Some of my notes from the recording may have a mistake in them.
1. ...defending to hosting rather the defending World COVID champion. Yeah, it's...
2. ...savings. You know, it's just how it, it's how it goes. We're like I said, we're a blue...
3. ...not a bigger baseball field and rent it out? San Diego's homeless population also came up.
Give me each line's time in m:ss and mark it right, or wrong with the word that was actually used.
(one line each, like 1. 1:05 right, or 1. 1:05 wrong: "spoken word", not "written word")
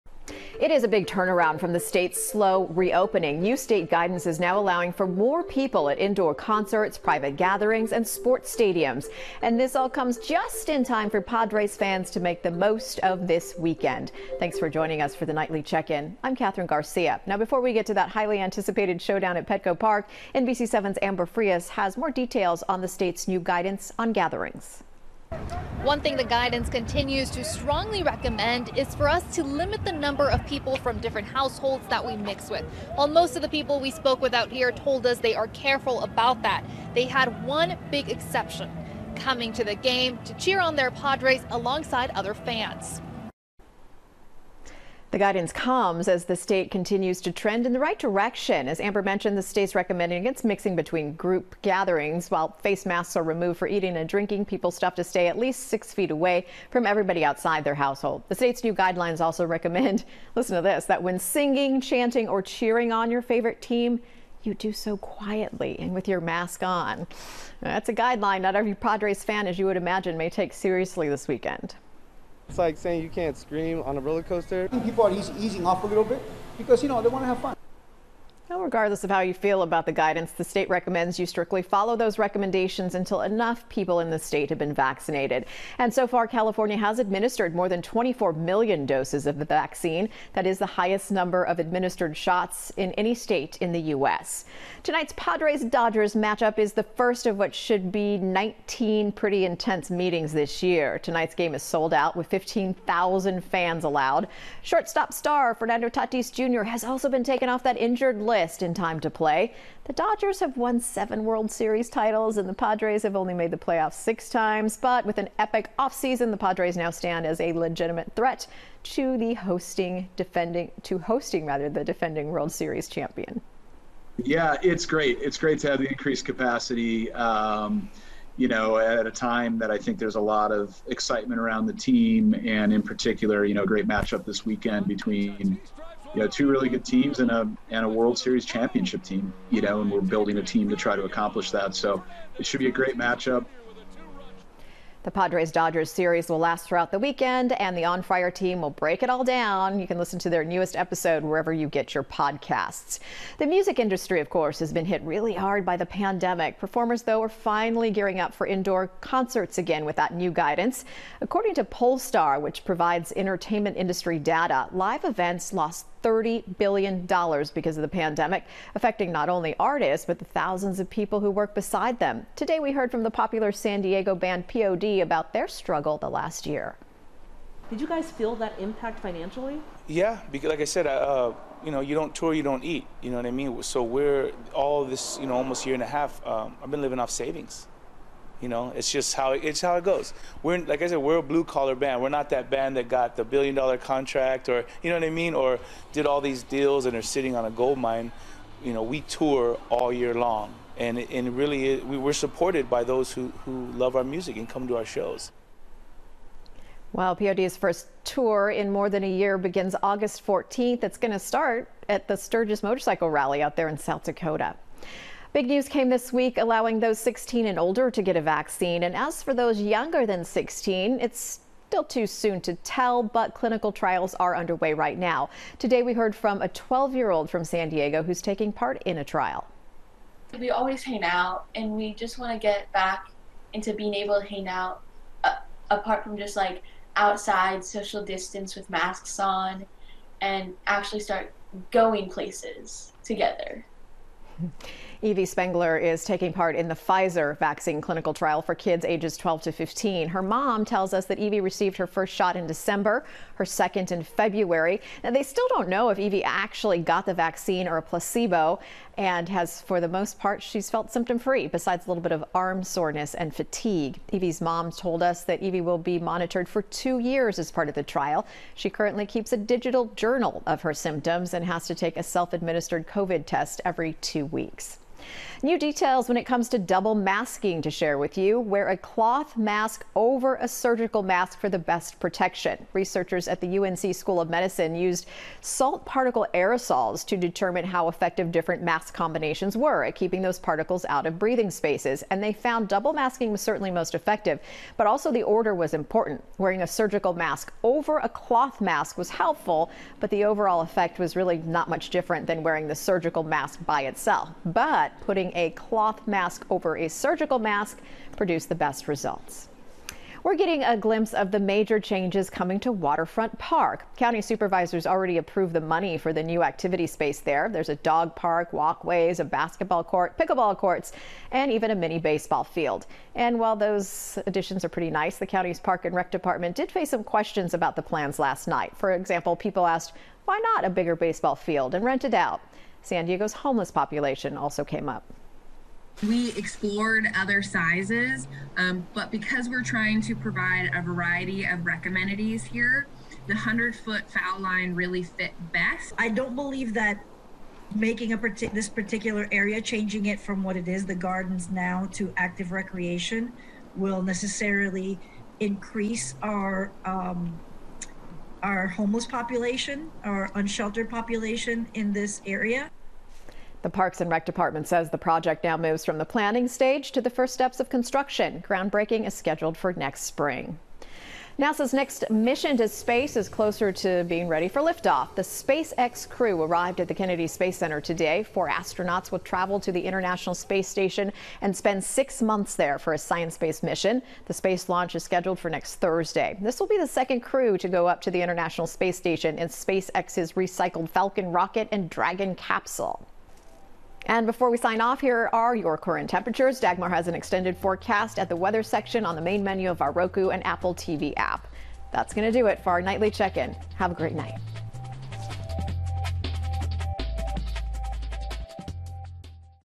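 1. 2:00 wrong: "Series", not "COVID"
2. 3:07 right
3. 5:30 right.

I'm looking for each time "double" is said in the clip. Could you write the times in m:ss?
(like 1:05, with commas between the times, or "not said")
4:36, 4:52.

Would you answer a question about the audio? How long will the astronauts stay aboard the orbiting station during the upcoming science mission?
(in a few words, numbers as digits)
6 months.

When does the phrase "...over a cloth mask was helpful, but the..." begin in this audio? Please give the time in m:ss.
4:57.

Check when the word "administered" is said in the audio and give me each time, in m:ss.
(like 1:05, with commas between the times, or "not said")
1:26, 1:31, 4:32.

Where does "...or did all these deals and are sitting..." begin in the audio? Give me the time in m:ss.
3:15.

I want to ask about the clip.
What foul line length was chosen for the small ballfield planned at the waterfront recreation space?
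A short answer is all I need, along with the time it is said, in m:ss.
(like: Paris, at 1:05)
100 feet, at 5:43.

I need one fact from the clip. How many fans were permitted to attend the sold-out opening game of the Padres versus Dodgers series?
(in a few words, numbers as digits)
15,000.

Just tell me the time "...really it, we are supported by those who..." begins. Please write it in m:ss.
3:21.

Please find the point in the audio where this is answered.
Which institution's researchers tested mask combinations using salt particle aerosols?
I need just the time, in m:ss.
4:43.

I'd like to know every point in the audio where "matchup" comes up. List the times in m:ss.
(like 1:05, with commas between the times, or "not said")
1:36, 2:13, 2:22.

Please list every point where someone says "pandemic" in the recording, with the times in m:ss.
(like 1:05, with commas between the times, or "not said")
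2:35, 2:47.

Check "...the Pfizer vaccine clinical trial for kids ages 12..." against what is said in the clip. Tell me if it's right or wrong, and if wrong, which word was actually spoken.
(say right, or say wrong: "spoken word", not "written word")
right.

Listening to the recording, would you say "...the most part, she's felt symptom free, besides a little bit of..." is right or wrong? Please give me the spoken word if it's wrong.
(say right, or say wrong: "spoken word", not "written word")
right.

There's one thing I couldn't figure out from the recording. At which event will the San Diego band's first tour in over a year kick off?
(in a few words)
Sturgis Motorcycle Rally.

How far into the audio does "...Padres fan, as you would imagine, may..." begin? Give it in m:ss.
1:08.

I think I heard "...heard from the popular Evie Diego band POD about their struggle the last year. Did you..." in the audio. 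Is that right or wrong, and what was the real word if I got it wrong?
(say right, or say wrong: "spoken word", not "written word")
wrong: "San", not "Evie".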